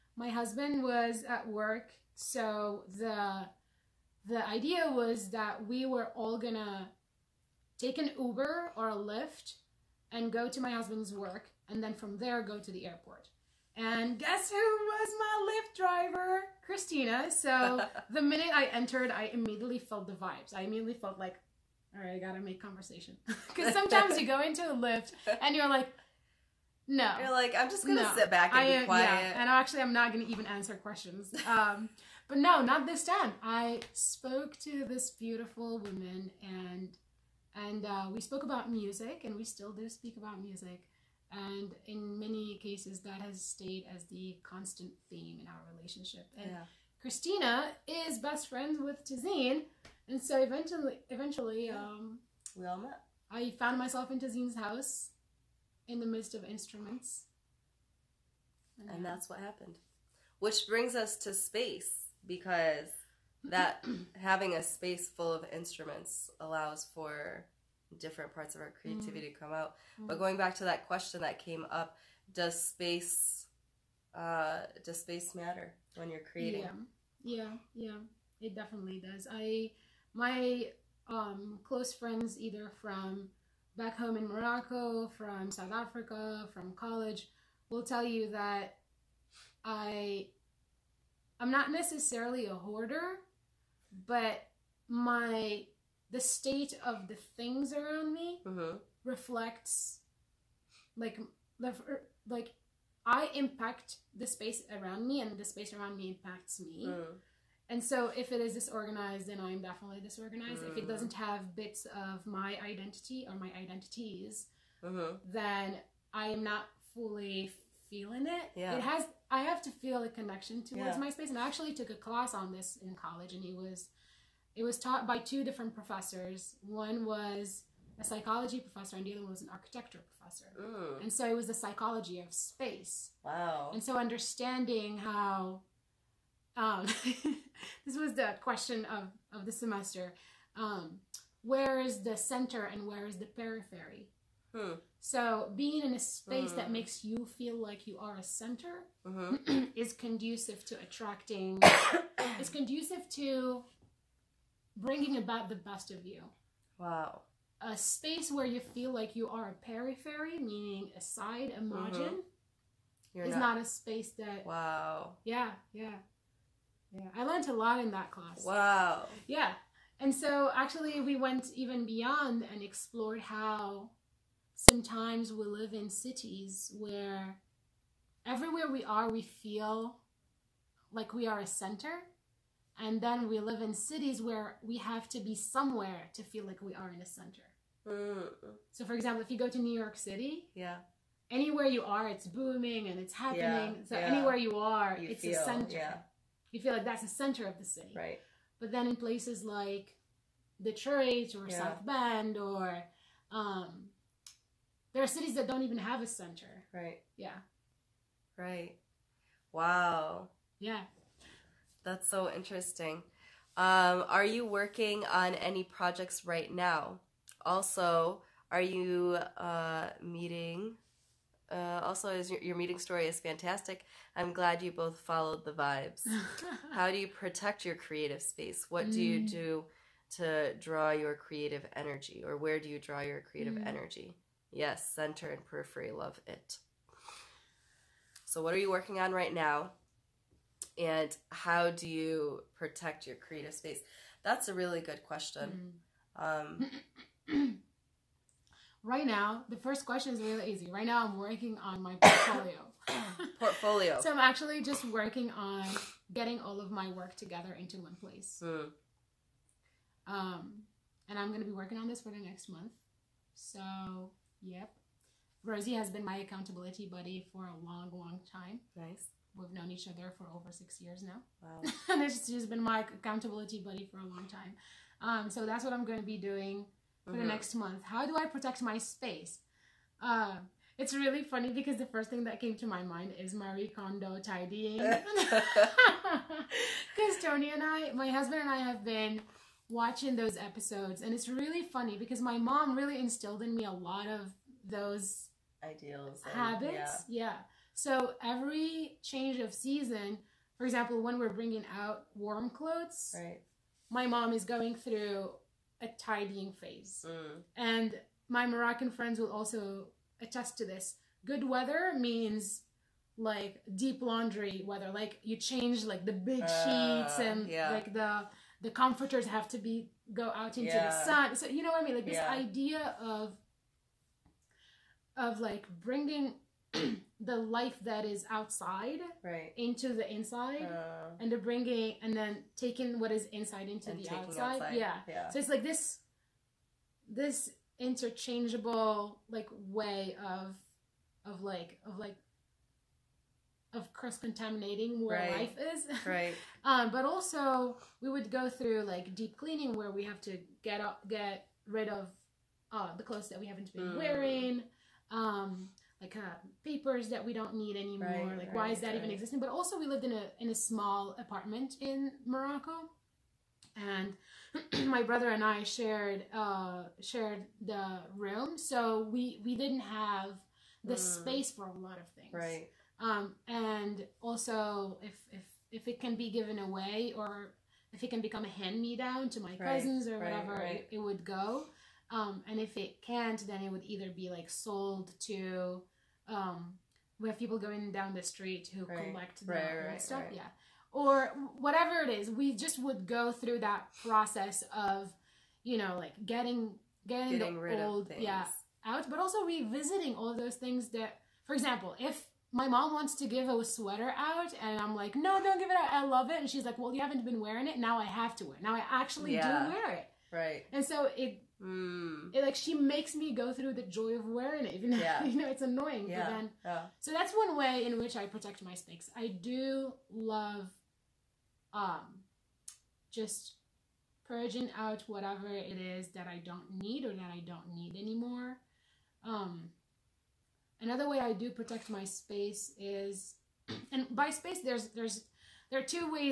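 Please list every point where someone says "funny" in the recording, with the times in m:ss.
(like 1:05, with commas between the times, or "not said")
4:41, 4:51.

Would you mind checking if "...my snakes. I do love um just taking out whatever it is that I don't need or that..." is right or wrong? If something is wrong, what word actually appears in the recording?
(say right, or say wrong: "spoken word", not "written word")
wrong: "purging", not "taking".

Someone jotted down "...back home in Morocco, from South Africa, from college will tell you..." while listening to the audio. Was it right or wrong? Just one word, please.
right.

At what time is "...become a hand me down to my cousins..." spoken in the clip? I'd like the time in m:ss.
6:18.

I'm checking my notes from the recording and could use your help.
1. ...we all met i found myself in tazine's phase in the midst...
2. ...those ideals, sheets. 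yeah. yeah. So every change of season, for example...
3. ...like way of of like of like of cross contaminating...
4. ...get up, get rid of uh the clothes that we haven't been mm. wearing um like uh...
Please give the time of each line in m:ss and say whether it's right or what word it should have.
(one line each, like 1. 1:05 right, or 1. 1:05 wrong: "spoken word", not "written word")
1. 0:52 wrong: "house", not "phase"
2. 4:54 wrong: "habits", not "sheets"
3. 5:39 right
4. 5:50 right.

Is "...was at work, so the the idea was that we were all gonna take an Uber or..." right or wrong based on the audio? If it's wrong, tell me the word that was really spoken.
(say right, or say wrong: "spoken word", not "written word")
right.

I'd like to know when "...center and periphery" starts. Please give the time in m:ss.
3:54.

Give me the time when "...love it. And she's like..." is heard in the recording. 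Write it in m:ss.
6:46.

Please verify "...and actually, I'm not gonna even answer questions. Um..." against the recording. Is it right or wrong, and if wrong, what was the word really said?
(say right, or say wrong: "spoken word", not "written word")
right.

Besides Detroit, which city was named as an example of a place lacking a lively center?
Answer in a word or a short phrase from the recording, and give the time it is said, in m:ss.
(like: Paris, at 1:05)
South Bend, at 3:21.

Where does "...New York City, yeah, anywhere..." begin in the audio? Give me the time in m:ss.
3:09.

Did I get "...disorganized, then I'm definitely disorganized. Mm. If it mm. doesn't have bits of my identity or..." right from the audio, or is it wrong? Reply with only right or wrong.
right.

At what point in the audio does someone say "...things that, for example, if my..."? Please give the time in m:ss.
6:40.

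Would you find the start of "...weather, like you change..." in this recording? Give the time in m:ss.
5:14.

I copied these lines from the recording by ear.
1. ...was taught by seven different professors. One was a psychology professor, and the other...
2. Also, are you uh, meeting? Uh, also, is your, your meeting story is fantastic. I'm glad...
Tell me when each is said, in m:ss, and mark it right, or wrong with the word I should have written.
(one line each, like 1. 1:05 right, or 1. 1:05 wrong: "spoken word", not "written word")
1. 2:04 wrong: "two", not "seven"
2. 3:37 right.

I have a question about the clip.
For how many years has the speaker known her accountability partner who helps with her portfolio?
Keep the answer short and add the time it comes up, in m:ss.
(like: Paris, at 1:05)
6, at 4:30.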